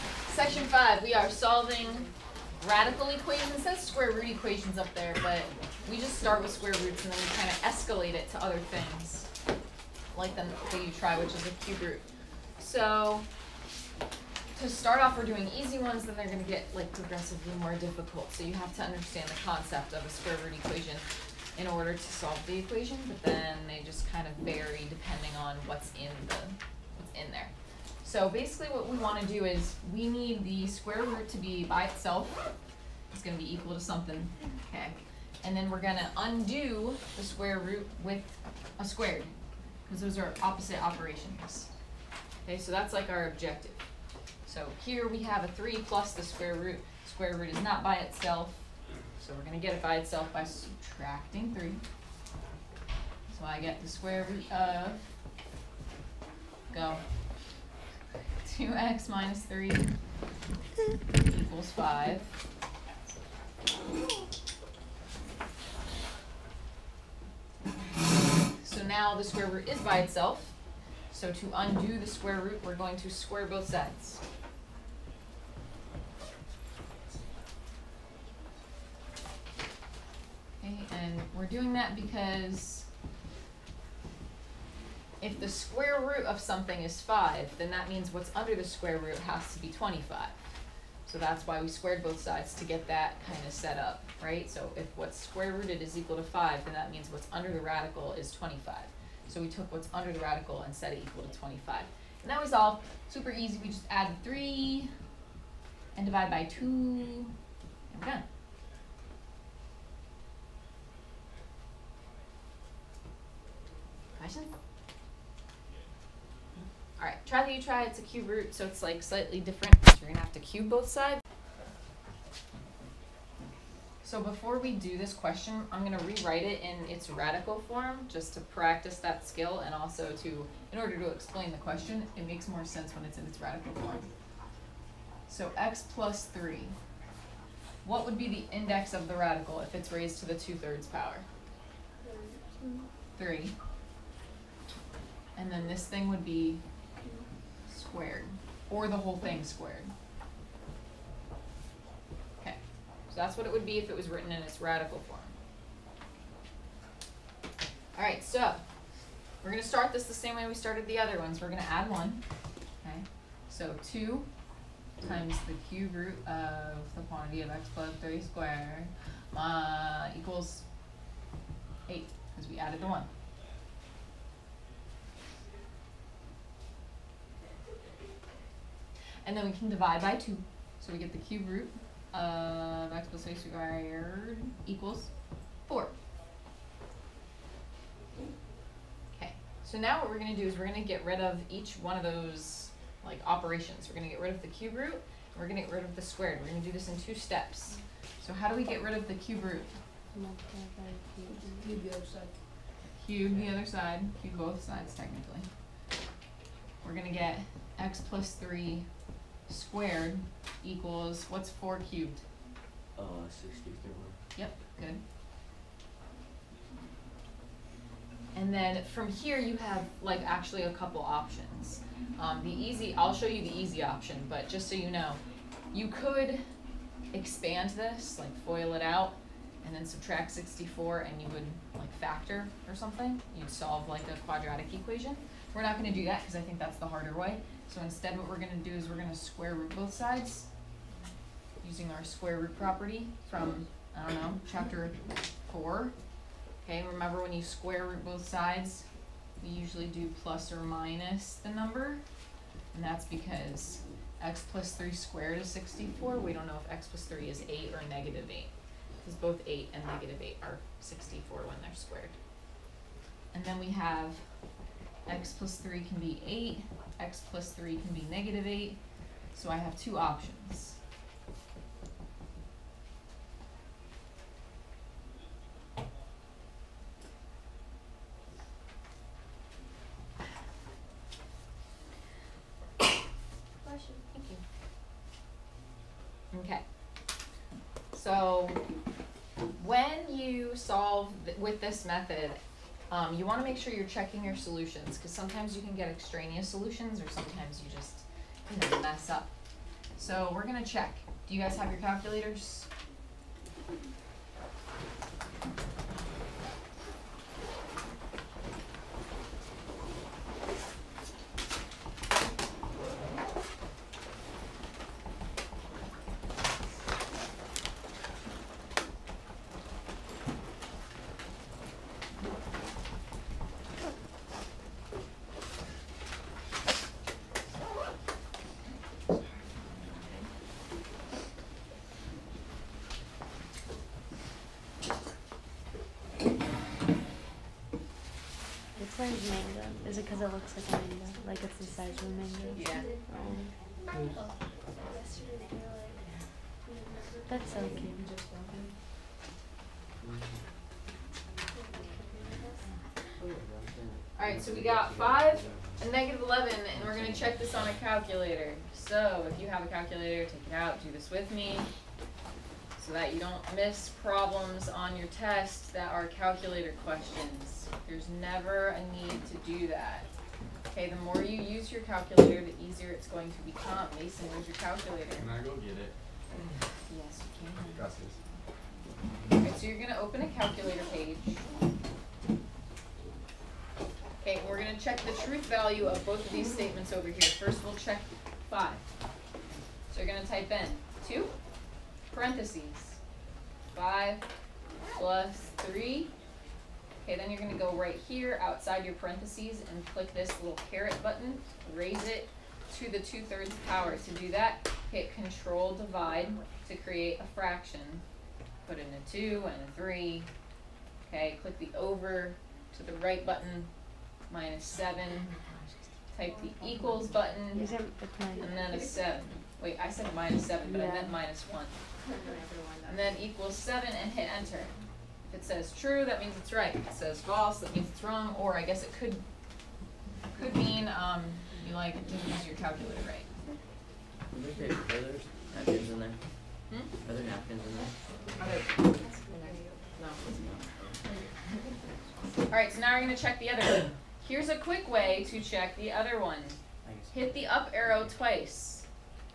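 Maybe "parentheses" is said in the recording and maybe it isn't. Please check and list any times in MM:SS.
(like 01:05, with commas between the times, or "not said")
06:32, 06:38.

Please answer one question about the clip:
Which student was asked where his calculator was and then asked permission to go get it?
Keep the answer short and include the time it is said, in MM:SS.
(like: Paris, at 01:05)
Mason, at 06:13.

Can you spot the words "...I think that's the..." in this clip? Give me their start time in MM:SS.
03:56.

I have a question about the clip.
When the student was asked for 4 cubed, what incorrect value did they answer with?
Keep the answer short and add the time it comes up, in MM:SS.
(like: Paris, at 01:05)
63, at 03:33.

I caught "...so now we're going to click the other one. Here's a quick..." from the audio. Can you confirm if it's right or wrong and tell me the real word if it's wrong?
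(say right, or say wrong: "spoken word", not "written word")
wrong: "check", not "click".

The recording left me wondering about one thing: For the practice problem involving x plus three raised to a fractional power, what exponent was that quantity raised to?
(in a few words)
two-thirds.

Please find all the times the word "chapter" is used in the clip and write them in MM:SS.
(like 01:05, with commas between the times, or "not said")
04:04.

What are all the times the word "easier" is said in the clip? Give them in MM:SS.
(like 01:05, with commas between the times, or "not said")
06:12.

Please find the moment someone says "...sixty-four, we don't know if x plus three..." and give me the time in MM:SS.
04:15.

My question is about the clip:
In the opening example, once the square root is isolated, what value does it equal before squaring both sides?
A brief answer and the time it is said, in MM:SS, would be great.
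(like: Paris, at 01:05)
5, at 01:01.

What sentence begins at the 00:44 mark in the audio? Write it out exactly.
So here we have a 3 plus the square root.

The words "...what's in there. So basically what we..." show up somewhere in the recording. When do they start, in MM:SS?
00:26.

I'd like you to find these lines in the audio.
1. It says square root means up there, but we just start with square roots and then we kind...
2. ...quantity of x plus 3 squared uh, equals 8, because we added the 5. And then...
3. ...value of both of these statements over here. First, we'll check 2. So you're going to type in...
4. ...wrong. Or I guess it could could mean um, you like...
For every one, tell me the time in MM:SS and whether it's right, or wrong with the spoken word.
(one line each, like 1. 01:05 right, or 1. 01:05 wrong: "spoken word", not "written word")
1. 00:03 wrong: "equations", not "means"
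2. 02:47 wrong: "1", not "5"
3. 06:25 wrong: "5", not "2"
4. 07:08 right.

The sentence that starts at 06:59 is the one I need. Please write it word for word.
Wait, I said minus seven, but I meant minus one.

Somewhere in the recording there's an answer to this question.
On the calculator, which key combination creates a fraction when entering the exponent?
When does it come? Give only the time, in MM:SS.
06:45.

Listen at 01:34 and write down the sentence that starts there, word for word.
So if what's square rooted is equal to 5, then that means what's under the radical is 25.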